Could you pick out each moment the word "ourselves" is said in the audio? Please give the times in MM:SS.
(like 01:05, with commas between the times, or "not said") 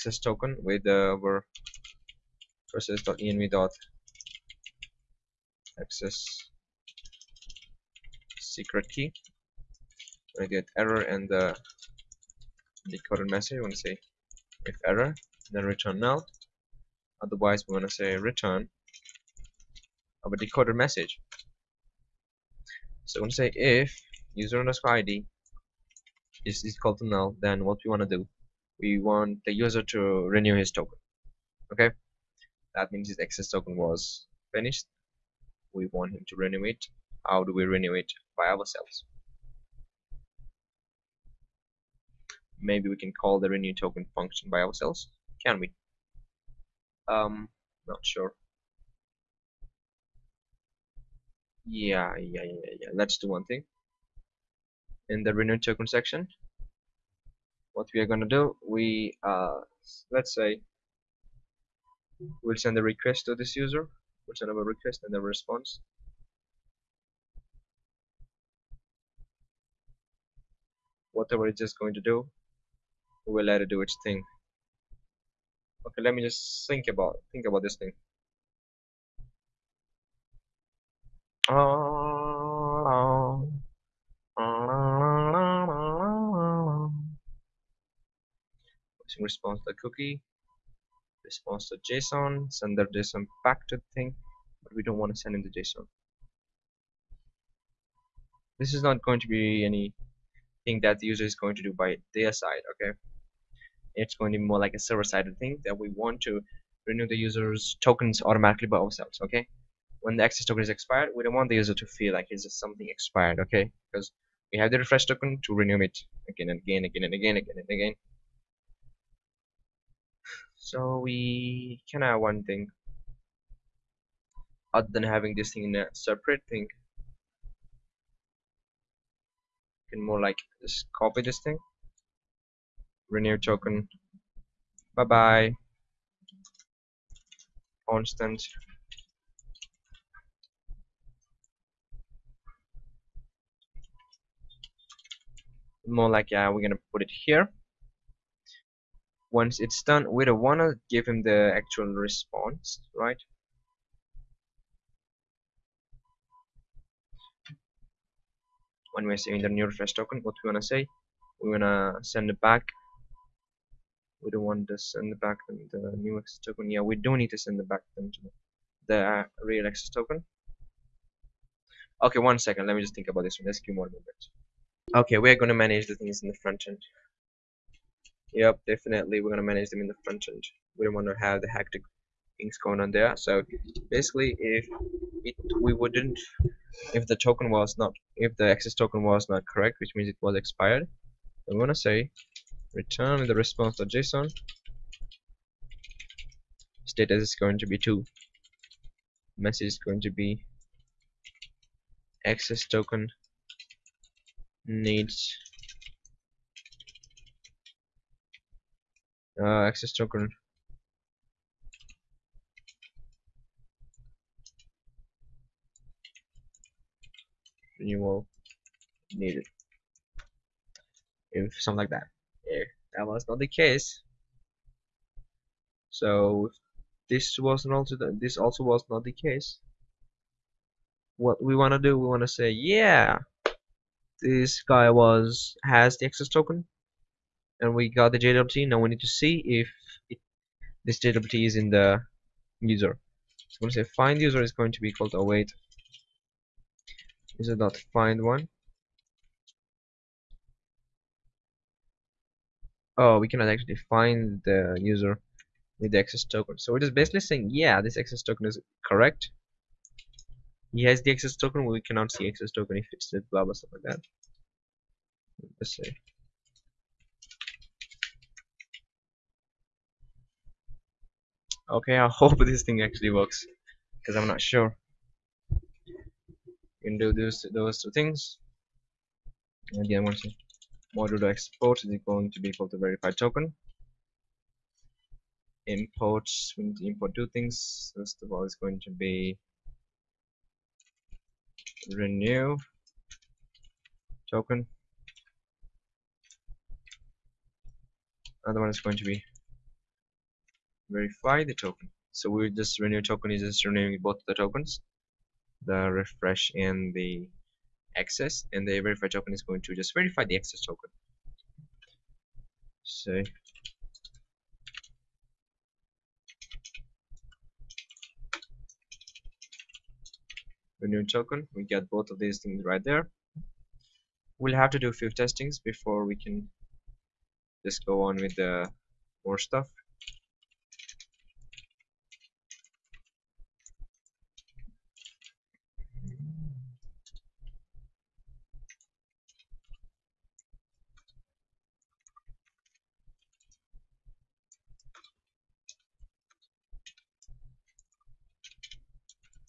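00:38, 00:44, 01:48.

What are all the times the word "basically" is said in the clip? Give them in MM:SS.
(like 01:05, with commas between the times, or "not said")
03:03, 04:16.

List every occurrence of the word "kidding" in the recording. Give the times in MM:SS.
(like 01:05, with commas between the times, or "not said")
not said.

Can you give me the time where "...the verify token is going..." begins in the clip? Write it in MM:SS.
05:08.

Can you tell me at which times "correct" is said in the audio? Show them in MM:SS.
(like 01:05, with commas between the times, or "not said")
03:09, 04:18.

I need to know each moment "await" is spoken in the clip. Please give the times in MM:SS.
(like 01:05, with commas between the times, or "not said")
04:05.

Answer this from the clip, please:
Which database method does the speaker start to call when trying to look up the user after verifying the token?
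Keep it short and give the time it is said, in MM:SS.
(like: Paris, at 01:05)
find one, at 04:07.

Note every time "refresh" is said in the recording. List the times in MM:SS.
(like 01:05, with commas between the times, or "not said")
01:54, 02:39, 05:06.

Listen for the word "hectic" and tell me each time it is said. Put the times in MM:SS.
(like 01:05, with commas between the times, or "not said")
03:01.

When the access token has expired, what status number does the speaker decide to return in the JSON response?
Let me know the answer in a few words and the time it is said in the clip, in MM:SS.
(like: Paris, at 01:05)
2, at 03:16.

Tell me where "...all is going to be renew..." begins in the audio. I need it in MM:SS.
04:48.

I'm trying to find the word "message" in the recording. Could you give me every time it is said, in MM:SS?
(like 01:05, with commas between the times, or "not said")
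00:13, 00:20, 03:19.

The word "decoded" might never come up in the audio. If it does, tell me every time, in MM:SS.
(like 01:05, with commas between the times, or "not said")
00:12, 00:20.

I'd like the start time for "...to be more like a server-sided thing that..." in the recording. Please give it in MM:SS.
01:44.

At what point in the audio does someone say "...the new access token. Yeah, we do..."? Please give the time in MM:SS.
02:45.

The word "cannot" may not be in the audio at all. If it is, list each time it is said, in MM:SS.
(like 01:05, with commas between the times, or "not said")
04:13, 04:21.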